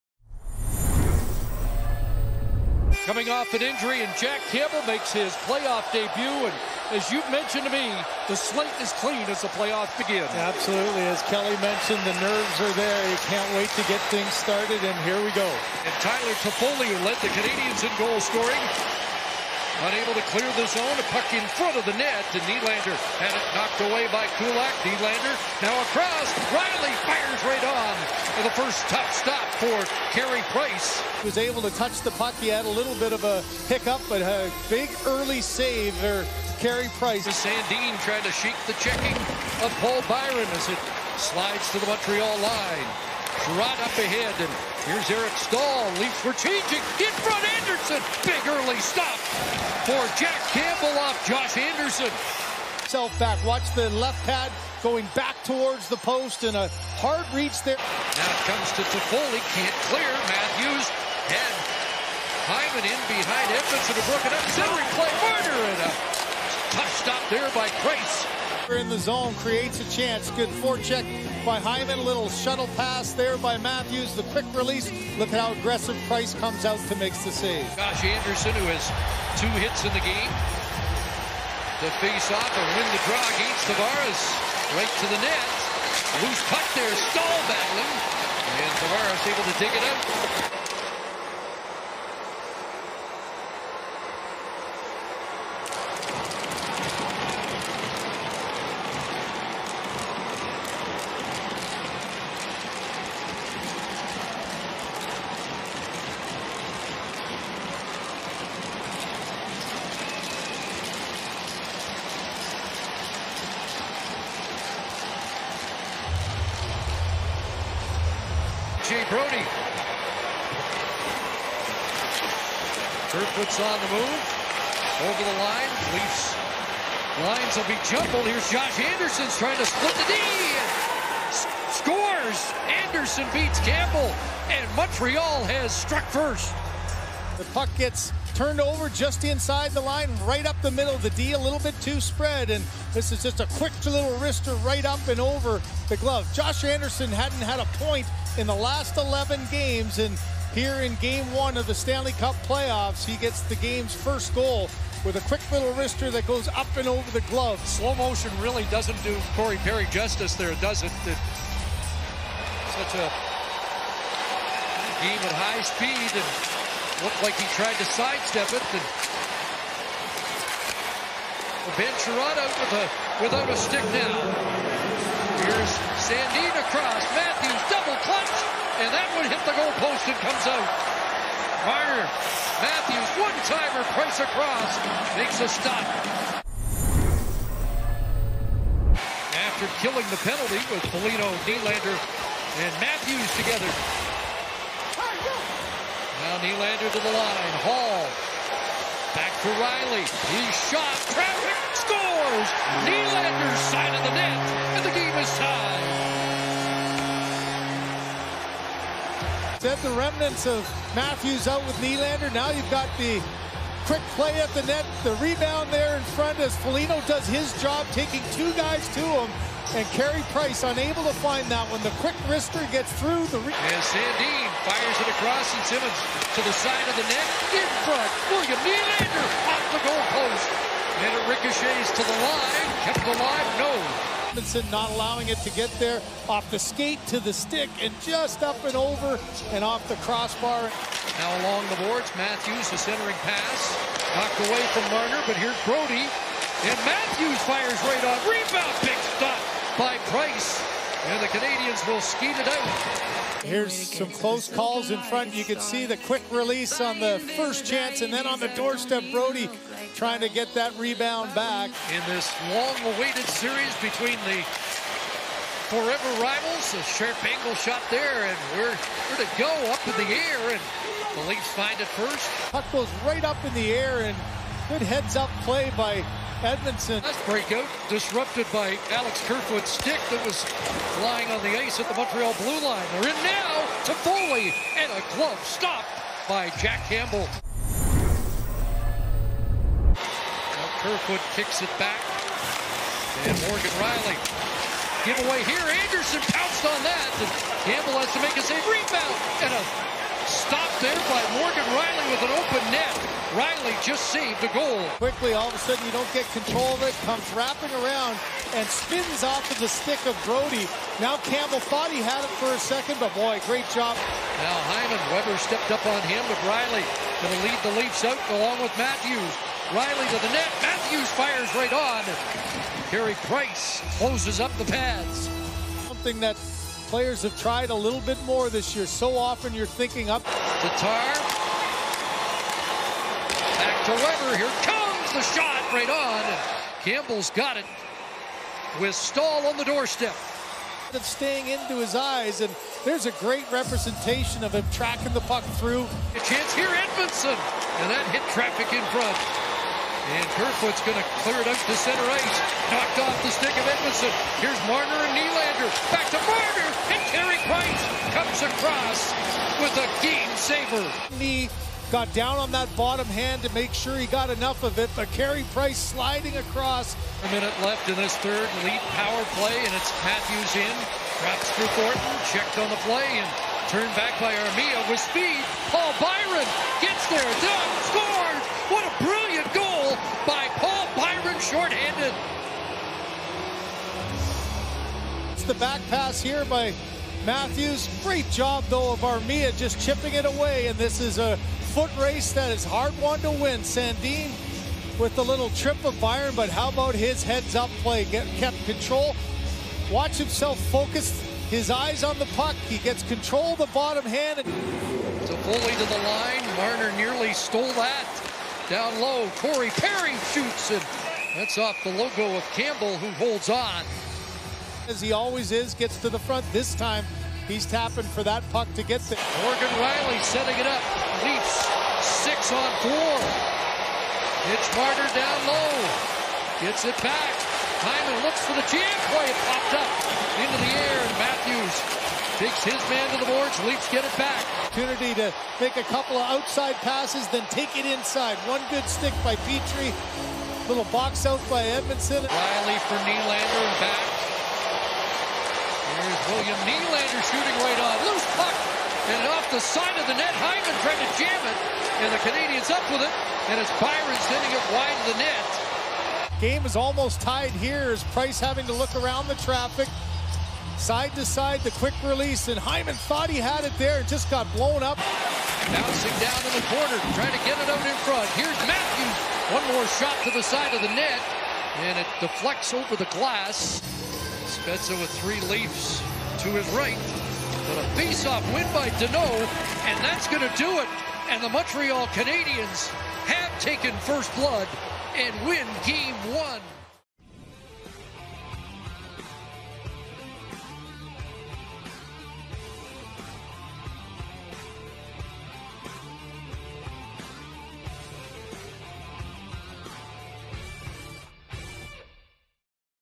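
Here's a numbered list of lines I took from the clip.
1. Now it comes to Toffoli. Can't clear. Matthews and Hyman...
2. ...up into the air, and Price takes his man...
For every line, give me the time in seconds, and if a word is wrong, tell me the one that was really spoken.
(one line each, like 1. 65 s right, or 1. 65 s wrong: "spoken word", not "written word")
1. 58 s right
2. 429 s wrong: "Matthews", not "Price".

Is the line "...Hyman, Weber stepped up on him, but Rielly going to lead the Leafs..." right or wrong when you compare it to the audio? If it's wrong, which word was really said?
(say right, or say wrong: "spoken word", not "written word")
right.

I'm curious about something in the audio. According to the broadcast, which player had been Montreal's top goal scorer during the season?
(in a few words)
Tyler Toffoli.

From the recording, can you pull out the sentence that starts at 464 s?
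Bouncing down in the corner, trying to get it out in front.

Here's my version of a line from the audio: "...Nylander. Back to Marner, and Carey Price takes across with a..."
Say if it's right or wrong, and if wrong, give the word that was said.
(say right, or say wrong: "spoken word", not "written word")
wrong: "comes", not "takes".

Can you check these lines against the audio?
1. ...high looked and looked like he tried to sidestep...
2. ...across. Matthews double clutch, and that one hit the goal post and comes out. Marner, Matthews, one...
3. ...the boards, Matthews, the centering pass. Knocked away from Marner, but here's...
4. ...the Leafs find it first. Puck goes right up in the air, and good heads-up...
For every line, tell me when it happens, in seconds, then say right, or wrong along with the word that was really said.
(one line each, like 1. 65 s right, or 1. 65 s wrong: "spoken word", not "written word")
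1. 165 s wrong: "speed", not "looked"
2. 176 s right
3. 241 s right
4. 271 s right.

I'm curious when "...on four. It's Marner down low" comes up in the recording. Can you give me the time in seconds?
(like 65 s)
422 s.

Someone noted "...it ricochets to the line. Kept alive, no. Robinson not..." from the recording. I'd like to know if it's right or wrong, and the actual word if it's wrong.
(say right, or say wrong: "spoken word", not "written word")
right.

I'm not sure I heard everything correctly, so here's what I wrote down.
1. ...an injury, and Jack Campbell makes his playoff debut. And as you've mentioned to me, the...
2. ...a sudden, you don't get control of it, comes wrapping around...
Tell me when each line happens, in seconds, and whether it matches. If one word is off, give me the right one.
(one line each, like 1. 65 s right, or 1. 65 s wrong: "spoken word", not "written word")
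1. 3 s right
2. 305 s right.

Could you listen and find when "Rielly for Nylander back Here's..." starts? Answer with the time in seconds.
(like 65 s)
442 s.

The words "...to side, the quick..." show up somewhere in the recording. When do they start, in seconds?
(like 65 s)
461 s.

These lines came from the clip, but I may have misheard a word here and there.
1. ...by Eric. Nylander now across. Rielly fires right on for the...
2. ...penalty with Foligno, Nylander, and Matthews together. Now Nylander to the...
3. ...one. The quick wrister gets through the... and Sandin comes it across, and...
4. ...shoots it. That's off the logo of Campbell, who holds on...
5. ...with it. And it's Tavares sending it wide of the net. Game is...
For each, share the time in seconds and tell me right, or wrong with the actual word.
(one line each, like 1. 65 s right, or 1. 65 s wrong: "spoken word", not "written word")
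1. 24 s wrong: "Kulak", not "Eric"
2. 190 s right
3. 221 s wrong: "fires", not "comes"
4. 410 s right
5. 452 s wrong: "Byron", not "Tavares".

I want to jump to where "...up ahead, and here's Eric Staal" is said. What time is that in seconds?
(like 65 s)
43 s.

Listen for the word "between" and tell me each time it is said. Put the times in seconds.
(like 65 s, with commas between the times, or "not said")
263 s.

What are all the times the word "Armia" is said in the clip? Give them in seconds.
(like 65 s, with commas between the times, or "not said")
374 s, 389 s.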